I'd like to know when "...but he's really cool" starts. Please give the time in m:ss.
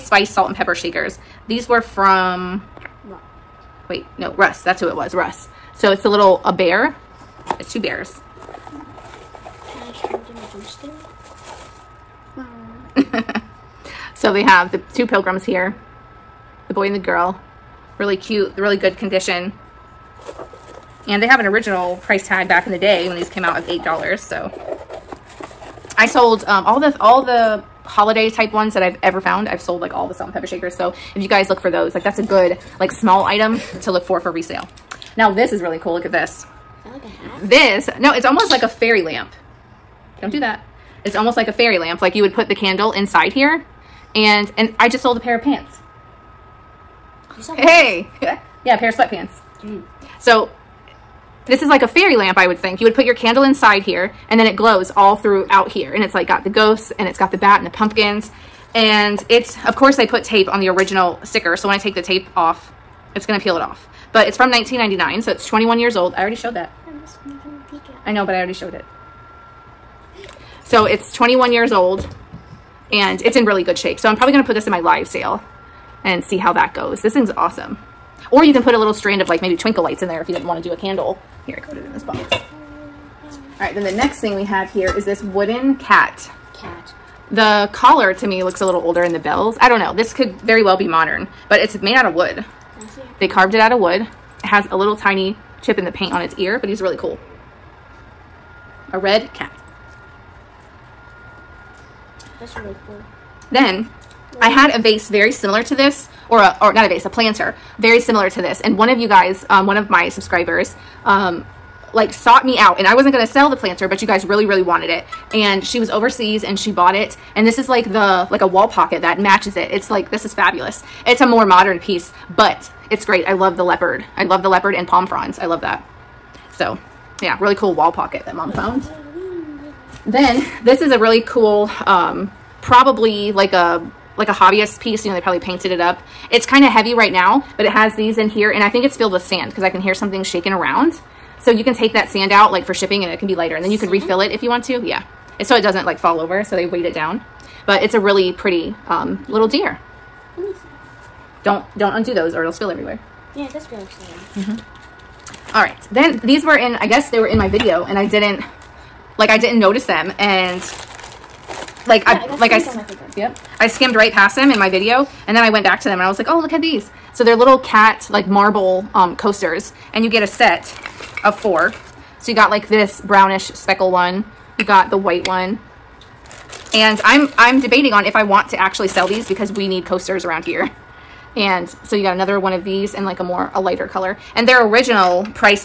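1:36.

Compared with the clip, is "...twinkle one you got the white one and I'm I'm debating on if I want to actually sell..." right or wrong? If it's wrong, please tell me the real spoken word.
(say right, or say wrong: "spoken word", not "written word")
wrong: "speckle", not "twinkle".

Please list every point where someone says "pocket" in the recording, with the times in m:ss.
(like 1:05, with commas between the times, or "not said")
1:58, 2:07.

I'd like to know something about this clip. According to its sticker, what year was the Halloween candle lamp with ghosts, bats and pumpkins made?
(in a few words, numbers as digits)
1999.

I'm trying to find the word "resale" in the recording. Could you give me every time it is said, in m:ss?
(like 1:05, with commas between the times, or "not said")
0:34.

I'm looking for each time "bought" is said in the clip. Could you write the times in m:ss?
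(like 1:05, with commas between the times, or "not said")
1:56.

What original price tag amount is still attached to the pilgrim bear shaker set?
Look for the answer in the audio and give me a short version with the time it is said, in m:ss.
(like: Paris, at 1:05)
$8, at 0:23.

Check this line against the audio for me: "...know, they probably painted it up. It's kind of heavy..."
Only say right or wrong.
right.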